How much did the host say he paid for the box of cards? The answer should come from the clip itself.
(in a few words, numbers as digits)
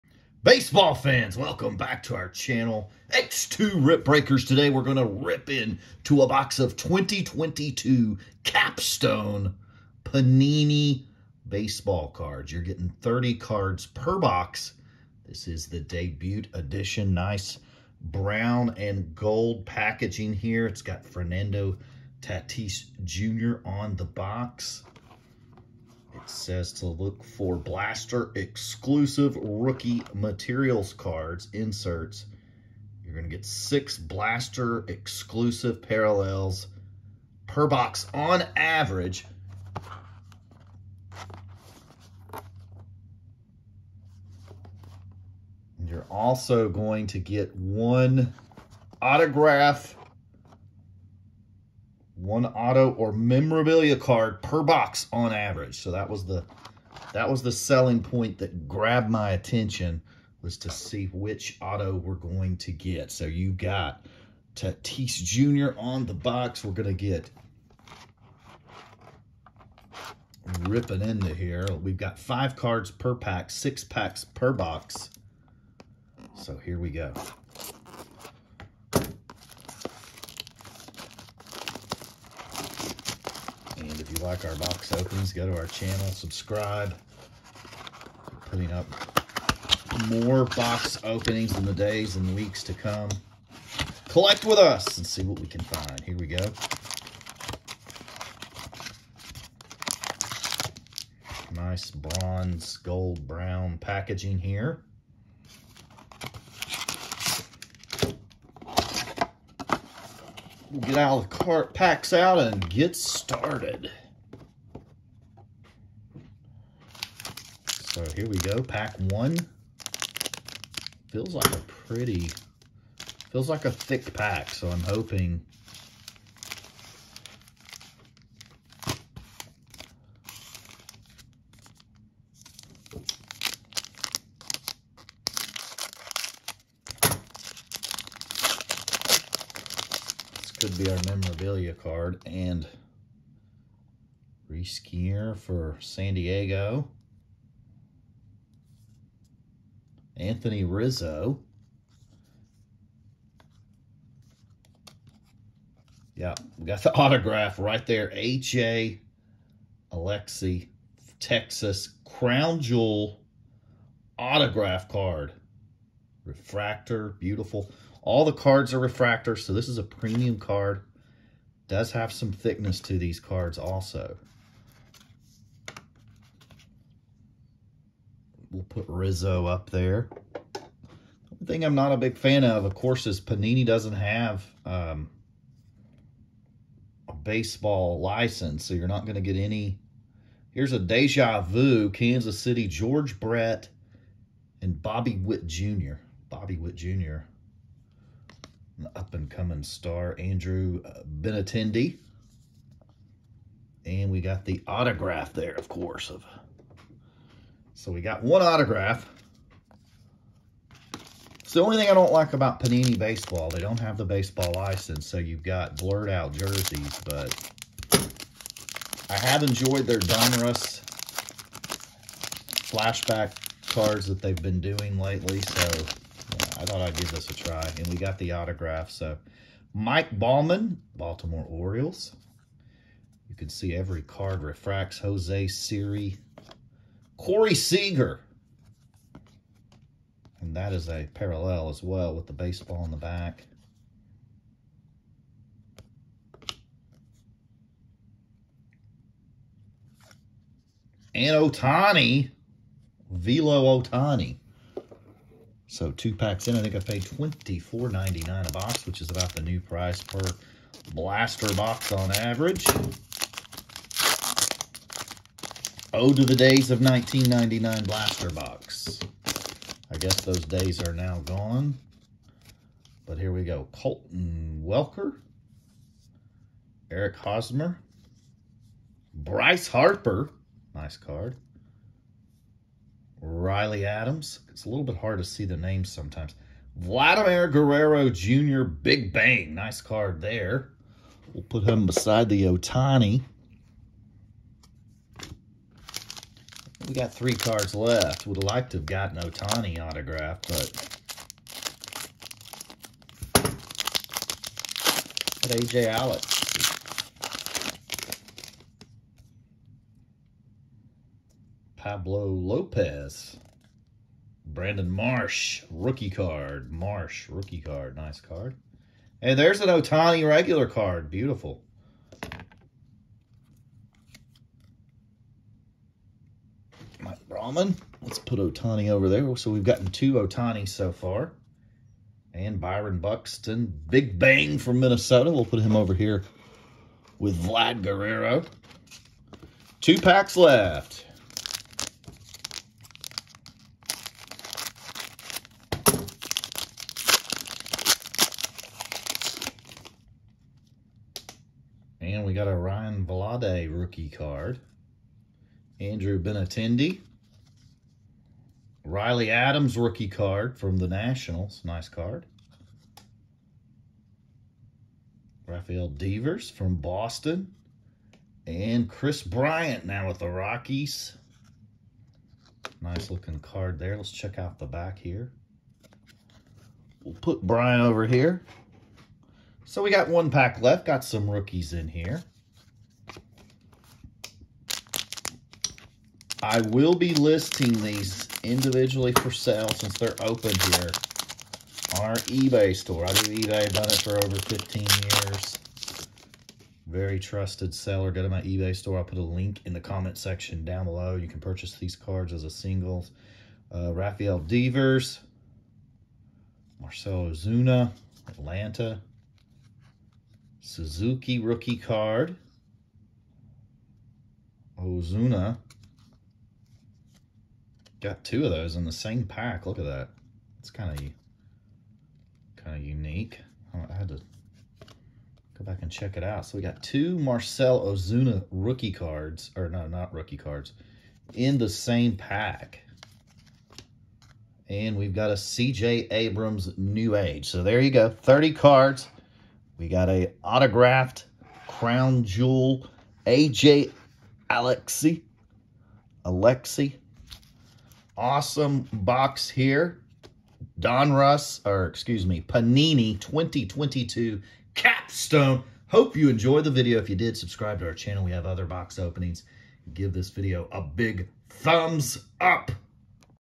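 $24.99.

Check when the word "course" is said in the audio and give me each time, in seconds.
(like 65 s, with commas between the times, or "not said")
182 s, 205 s.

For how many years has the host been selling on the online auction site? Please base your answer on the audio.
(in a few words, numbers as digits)
over 15 years.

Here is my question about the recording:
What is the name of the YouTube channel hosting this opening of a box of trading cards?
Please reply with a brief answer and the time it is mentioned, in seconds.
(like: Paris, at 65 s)
X2 Rip Breakers, at 3 s.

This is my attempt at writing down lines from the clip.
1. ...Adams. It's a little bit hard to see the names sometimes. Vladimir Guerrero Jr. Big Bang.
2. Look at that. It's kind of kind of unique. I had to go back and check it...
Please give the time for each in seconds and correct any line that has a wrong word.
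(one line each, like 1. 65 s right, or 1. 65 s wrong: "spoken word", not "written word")
1. 283 s right
2. 419 s right.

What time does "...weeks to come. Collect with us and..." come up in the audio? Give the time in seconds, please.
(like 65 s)
92 s.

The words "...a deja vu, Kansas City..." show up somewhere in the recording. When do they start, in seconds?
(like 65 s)
190 s.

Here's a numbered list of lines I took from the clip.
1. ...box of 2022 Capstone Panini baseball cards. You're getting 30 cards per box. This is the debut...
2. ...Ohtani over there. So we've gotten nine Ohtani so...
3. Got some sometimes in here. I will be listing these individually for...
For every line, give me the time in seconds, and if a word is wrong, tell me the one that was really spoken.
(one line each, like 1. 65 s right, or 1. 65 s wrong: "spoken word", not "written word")
1. 6 s right
2. 328 s wrong: "two", not "nine"
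3. 380 s wrong: "rookies", not "sometimes".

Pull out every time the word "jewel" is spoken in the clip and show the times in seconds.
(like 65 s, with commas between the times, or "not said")
162 s, 442 s.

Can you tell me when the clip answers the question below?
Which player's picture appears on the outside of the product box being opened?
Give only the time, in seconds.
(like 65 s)
21 s.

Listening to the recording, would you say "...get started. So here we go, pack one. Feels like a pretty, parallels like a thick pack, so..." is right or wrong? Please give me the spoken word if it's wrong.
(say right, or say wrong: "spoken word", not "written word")
wrong: "feels", not "parallels".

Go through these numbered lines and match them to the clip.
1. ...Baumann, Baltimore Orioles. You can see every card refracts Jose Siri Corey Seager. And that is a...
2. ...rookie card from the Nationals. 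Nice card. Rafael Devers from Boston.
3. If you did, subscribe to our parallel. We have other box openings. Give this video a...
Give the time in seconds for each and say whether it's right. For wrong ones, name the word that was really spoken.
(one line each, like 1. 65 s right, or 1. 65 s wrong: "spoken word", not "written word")
1. 230 s right
2. 359 s right
3. 456 s wrong: "channel", not "parallel".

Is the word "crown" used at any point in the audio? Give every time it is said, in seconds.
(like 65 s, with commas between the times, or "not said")
162 s, 441 s.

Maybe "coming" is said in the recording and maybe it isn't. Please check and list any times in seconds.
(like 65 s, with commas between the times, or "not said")
198 s.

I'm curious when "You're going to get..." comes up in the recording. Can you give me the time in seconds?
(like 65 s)
33 s.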